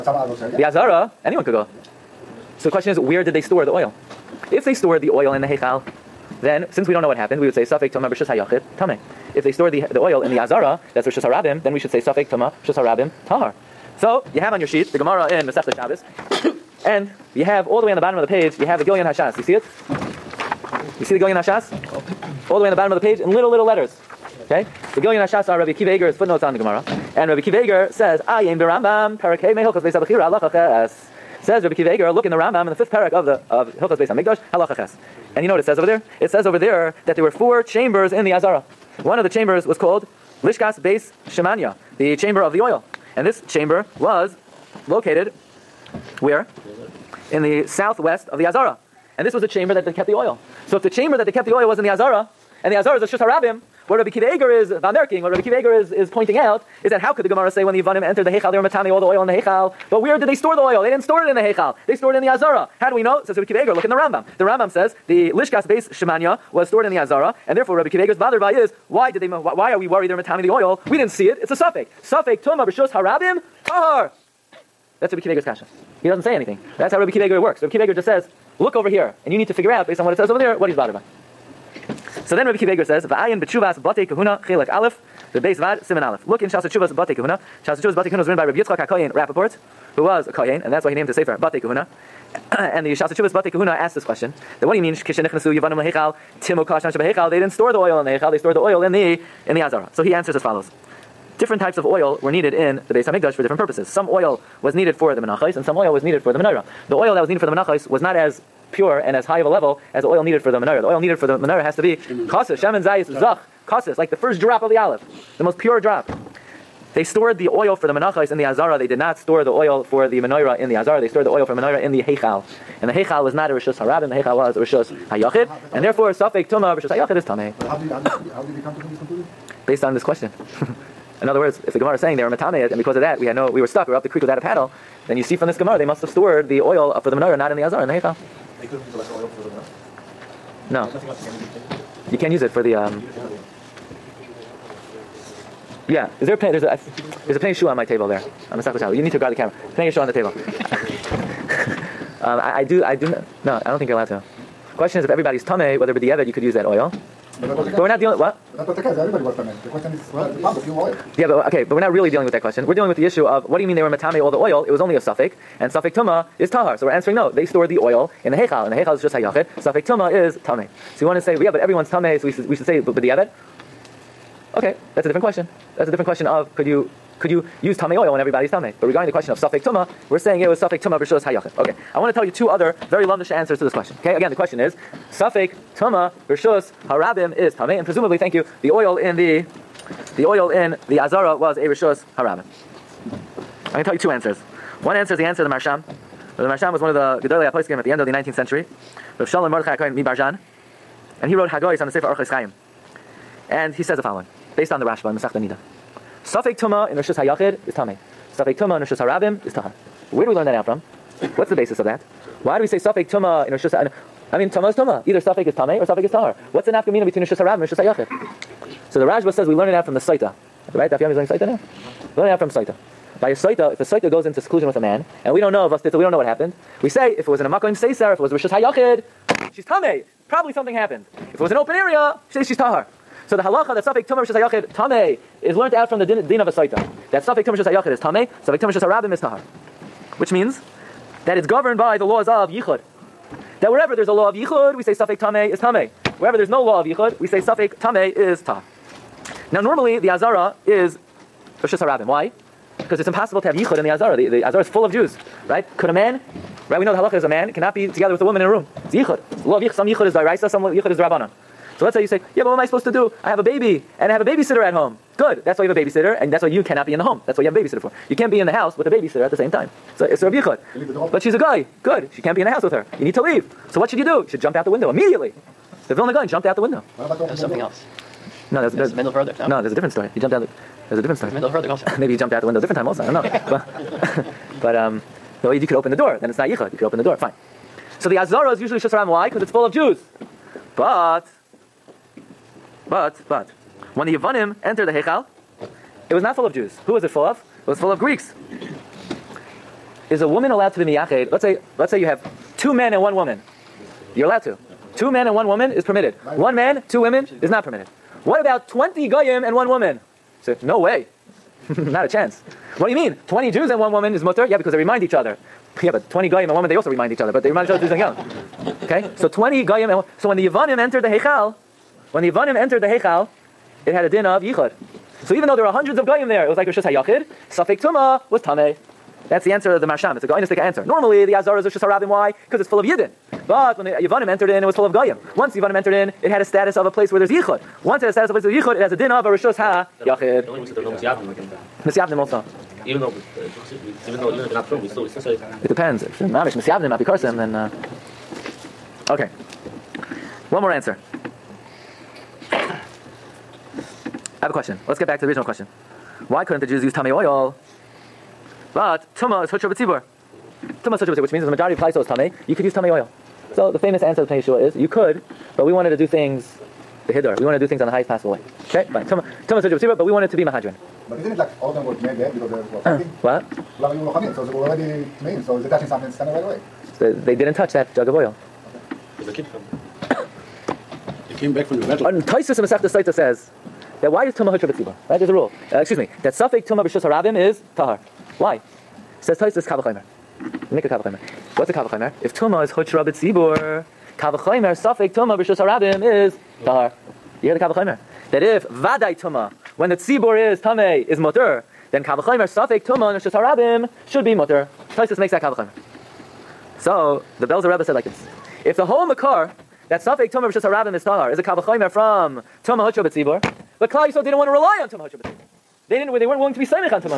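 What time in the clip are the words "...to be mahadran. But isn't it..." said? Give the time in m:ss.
6:10.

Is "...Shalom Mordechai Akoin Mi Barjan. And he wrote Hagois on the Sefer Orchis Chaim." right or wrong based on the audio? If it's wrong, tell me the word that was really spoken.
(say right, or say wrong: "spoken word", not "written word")
right.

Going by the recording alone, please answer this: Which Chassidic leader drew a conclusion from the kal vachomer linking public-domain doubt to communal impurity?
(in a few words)
The Belzer Rebbe.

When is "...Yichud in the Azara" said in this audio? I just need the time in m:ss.
4:13.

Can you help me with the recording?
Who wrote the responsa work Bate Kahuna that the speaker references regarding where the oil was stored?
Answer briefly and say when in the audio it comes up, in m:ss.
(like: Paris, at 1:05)
Rabbi Yitzchak HaKoyen Rappaport, at 1:28.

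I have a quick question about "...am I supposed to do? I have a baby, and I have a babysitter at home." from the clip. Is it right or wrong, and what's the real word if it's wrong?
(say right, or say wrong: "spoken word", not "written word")
right.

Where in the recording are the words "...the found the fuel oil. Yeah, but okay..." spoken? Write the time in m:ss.
2:40.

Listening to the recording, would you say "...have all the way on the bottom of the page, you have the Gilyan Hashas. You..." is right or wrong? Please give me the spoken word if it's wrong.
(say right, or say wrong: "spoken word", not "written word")
right.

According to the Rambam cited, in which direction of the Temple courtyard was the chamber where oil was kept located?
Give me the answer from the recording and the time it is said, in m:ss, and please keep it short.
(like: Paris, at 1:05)
Southwest, at 0:47.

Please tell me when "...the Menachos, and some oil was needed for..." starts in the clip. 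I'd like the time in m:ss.
1:45.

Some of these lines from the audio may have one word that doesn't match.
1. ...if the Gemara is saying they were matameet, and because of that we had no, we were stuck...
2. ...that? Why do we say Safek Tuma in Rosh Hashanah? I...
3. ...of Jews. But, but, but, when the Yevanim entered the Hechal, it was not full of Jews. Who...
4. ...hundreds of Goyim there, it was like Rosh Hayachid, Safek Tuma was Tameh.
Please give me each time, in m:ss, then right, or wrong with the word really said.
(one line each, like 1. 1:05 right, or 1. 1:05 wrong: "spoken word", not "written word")
1. 2:11 right
2. 3:31 right
3. 4:49 right
4. 5:25 right.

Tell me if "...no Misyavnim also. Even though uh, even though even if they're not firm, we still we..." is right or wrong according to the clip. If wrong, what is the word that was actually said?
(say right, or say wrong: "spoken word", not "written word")
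right.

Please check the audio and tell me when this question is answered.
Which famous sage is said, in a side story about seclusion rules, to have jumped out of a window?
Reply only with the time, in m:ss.
4:35.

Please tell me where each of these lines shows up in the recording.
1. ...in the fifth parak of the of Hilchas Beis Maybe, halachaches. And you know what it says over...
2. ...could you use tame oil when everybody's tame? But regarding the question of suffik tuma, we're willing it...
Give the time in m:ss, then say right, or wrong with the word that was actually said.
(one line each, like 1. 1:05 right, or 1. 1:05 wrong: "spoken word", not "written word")
1. 0:32 wrong: "Hamikdash", not "Maybe"
2. 2:57 wrong: "saying", not "willing".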